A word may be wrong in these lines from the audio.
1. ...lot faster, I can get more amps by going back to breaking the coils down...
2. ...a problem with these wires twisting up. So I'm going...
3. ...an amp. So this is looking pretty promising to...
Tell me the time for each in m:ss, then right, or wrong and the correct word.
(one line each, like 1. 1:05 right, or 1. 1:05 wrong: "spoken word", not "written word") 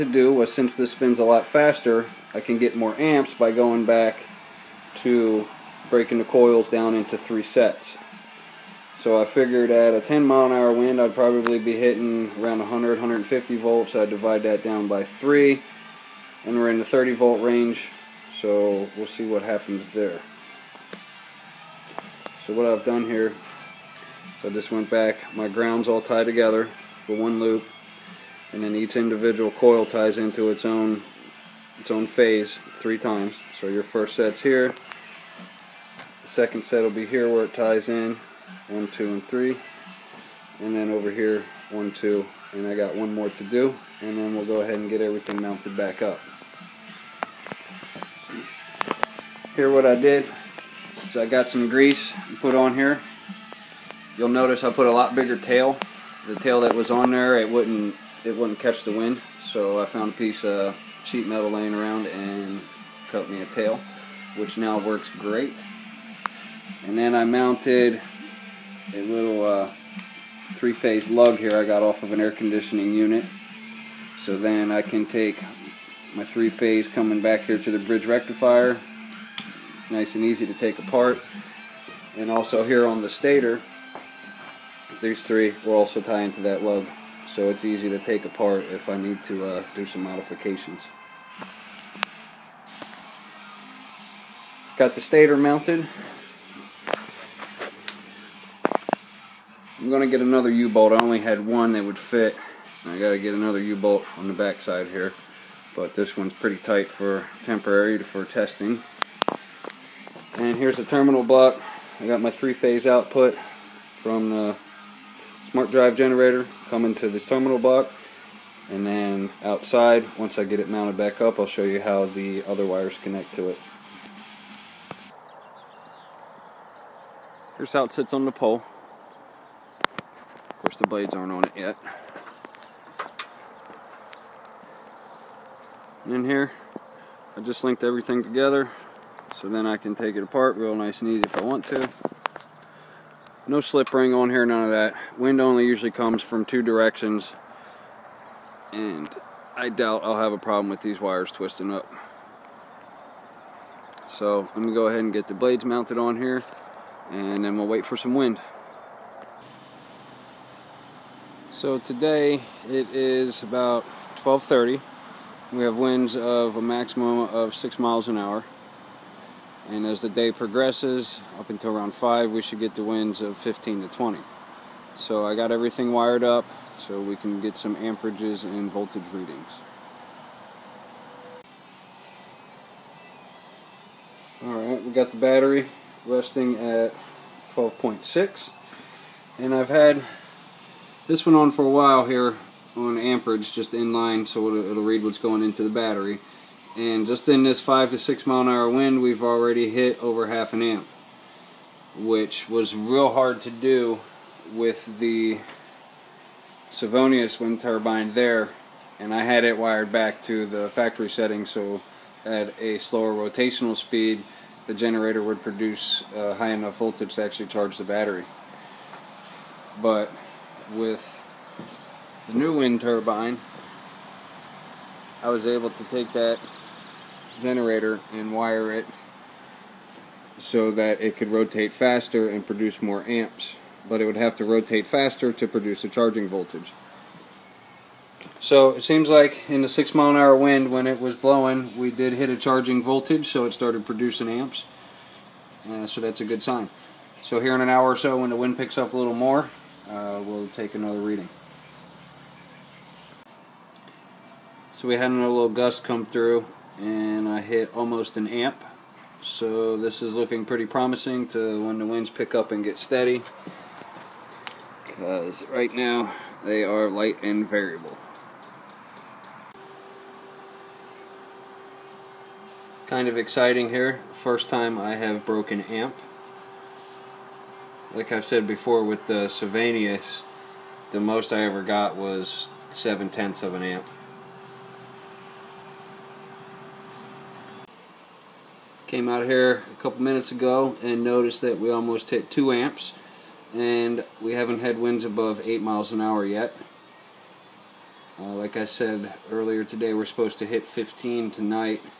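1. 0:01 right
2. 2:30 right
3. 4:18 right.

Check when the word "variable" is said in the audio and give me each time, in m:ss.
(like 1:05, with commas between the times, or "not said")
4:27.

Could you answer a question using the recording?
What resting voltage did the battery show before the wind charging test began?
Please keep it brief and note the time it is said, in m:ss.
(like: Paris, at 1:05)
12.6, at 3:07.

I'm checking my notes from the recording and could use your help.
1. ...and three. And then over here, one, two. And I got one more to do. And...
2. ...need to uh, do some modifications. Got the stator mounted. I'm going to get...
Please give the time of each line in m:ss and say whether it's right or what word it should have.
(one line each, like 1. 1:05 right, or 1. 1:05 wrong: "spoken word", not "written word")
1. 0:39 right
2. 1:28 right.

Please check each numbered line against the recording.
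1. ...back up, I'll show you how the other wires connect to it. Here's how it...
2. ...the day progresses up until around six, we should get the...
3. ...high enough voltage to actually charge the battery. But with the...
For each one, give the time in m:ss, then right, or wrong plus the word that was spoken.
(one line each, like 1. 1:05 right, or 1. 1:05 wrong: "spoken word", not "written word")
1. 2:00 right
2. 2:50 wrong: "five", not "six"
3. 3:36 right.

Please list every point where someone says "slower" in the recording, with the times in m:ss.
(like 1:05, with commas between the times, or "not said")
3:32.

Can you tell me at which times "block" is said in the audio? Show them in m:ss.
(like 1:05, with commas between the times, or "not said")
1:51, 1:57.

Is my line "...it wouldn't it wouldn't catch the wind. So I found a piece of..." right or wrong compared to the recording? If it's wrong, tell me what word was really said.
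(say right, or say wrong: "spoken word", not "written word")
right.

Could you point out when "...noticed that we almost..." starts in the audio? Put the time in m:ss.
4:51.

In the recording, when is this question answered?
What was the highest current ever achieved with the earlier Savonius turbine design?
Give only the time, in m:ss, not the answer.
4:42.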